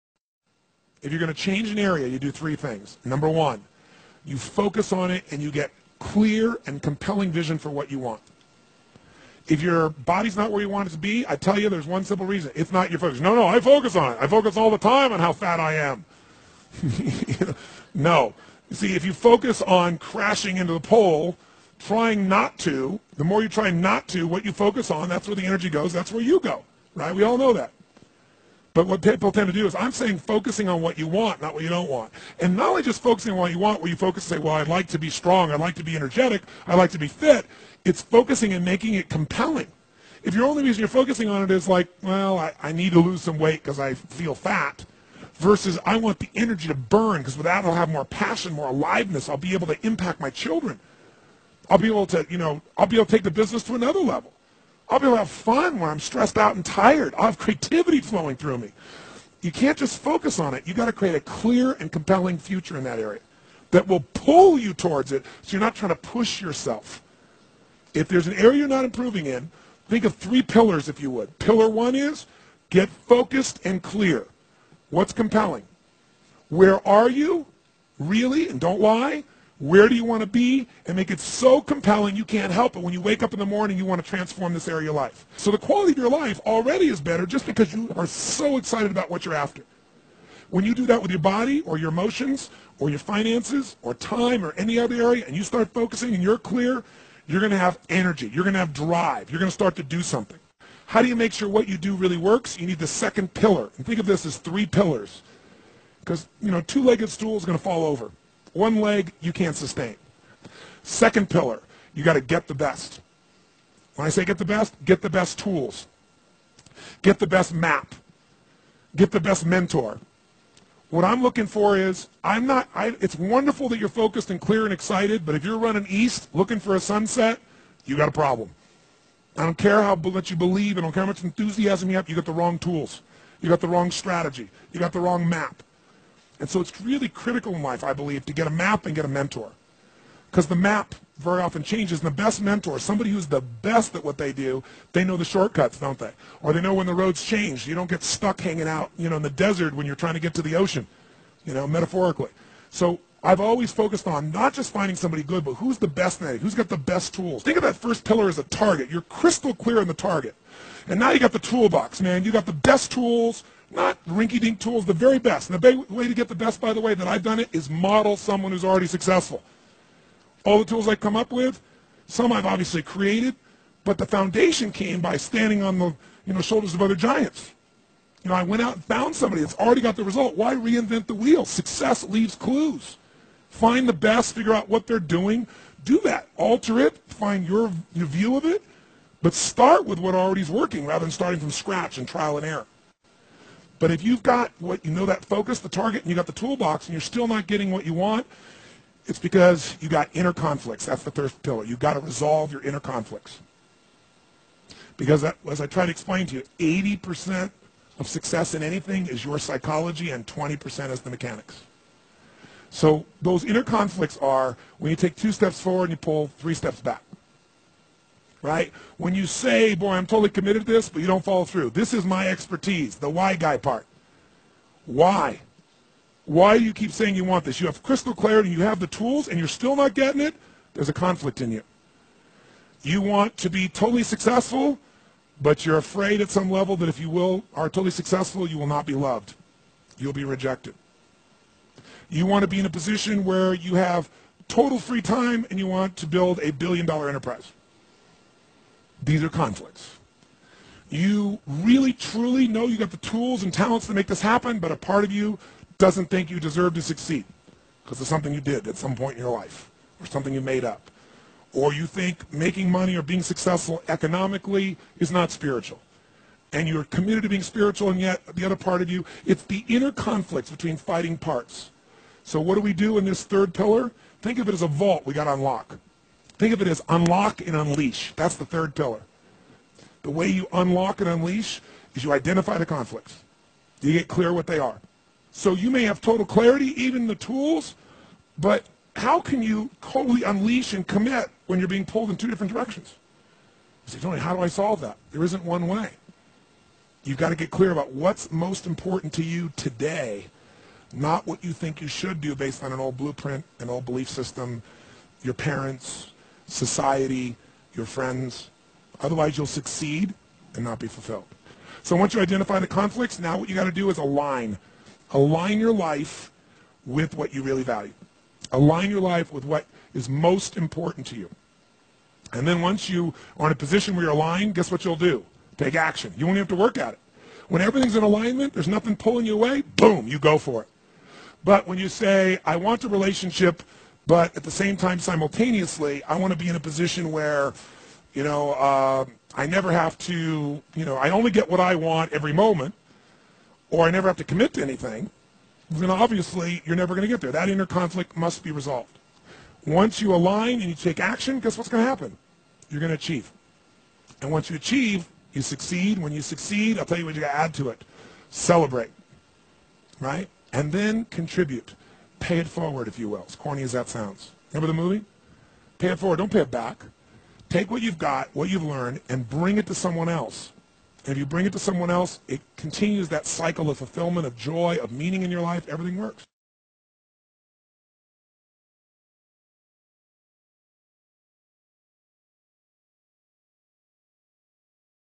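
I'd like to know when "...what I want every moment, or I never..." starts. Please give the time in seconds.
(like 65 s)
341 s.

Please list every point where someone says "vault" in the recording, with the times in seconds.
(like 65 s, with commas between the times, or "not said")
274 s.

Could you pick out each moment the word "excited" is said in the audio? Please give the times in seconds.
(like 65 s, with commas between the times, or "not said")
88 s, 124 s.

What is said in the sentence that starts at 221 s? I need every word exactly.
This is my expertise, the why guy part.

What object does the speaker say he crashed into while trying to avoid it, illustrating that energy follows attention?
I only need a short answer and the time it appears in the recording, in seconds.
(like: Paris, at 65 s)
the pole, at 20 s.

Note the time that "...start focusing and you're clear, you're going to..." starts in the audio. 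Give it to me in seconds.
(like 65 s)
95 s.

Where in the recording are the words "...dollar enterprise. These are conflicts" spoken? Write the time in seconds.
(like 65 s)
246 s.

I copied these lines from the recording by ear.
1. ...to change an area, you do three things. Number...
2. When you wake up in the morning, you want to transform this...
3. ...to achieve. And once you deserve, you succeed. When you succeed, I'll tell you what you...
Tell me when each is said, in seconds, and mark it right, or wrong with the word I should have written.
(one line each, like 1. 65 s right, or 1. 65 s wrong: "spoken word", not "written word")
1. 1 s right
2. 82 s right
3. 352 s wrong: "achieve", not "deserve".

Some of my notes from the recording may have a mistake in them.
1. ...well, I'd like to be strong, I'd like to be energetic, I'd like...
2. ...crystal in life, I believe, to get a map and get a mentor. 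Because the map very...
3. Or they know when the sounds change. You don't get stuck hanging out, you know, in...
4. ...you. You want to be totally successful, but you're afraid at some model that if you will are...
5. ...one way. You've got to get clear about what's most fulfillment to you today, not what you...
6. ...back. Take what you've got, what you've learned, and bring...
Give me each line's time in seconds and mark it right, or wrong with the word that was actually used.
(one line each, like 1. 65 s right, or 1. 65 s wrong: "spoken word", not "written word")
1. 34 s right
2. 137 s wrong: "critical", not "crystal"
3. 146 s wrong: "roads", not "sounds"
4. 231 s wrong: "level", not "model"
5. 295 s wrong: "important", not "fulfillment"
6. 366 s right.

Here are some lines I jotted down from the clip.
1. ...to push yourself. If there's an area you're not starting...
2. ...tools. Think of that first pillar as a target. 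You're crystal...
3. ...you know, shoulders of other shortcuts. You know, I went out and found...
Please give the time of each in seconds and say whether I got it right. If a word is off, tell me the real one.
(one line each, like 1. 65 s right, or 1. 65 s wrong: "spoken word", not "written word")
1. 65 s wrong: "improving", not "starting"
2. 157 s right
3. 176 s wrong: "giants", not "shortcuts".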